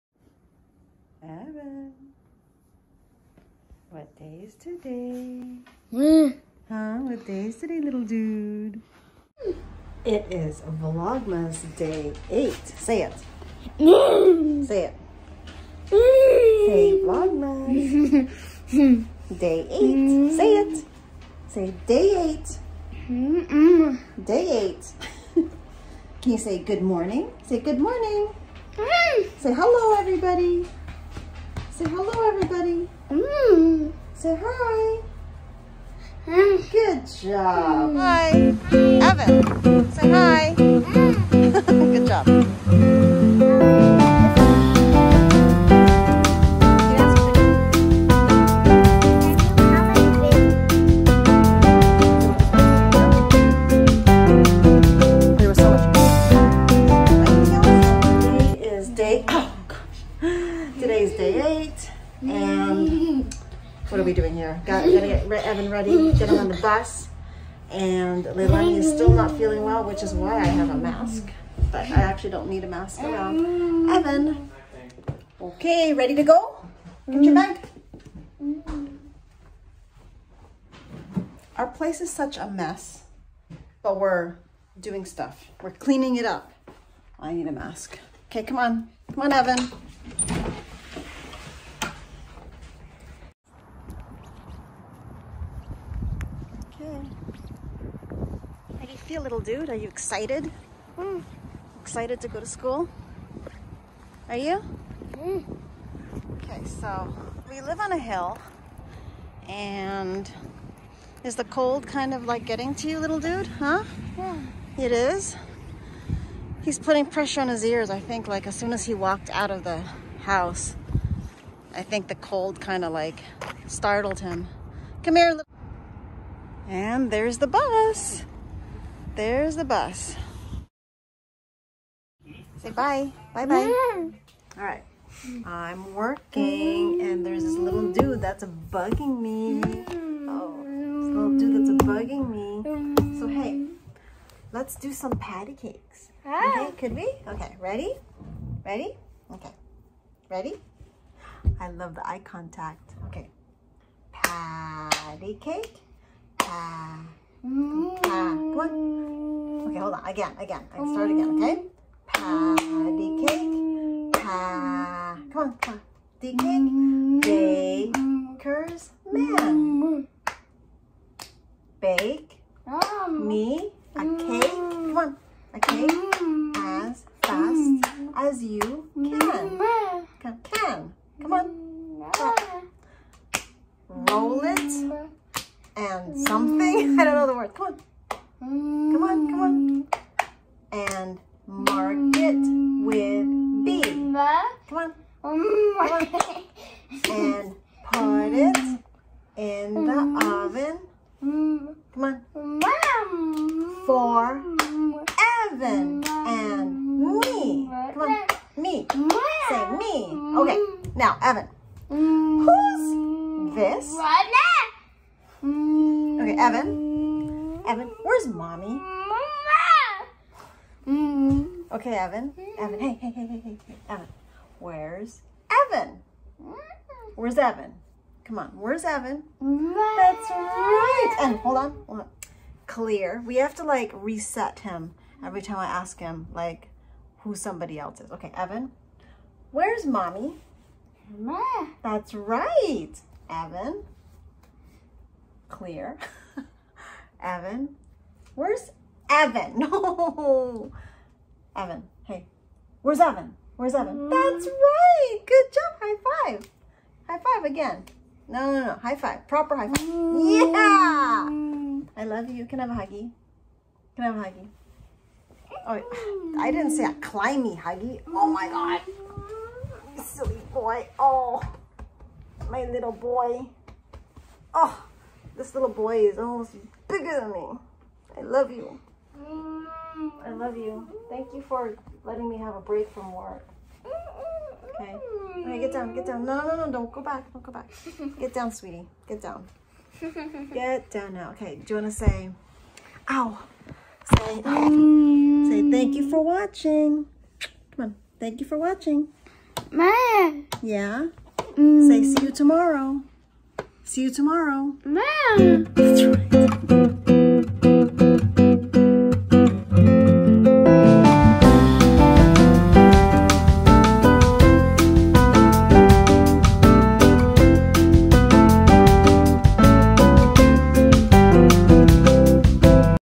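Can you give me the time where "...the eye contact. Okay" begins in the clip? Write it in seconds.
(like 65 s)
151 s.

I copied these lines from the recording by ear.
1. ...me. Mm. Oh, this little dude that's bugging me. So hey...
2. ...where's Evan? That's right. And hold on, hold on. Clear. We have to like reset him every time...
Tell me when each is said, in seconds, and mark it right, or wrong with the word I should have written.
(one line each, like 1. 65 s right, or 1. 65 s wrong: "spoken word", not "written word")
1. 139 s right
2. 228 s right.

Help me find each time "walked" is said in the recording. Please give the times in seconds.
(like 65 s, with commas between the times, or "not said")
118 s.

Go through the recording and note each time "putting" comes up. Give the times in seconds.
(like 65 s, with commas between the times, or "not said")
116 s.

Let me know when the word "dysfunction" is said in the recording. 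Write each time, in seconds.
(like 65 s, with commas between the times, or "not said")
not said.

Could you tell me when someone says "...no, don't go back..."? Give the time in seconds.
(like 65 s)
286 s.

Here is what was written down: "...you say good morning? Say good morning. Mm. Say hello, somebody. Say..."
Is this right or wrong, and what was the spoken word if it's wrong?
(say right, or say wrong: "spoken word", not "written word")
wrong: "everybody", not "somebody".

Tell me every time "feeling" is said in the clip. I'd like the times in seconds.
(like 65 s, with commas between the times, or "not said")
69 s.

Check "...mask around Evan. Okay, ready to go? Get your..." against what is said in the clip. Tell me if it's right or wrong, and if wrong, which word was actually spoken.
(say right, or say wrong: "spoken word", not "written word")
right.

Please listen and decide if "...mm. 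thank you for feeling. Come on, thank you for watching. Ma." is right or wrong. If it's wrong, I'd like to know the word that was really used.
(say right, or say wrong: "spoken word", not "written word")
wrong: "watching", not "feeling".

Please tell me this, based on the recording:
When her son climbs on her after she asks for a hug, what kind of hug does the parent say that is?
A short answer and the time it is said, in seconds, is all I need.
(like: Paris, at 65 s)
a climby huggy, at 266 s.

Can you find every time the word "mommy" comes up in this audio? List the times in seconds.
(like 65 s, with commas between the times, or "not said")
218 s, 239 s.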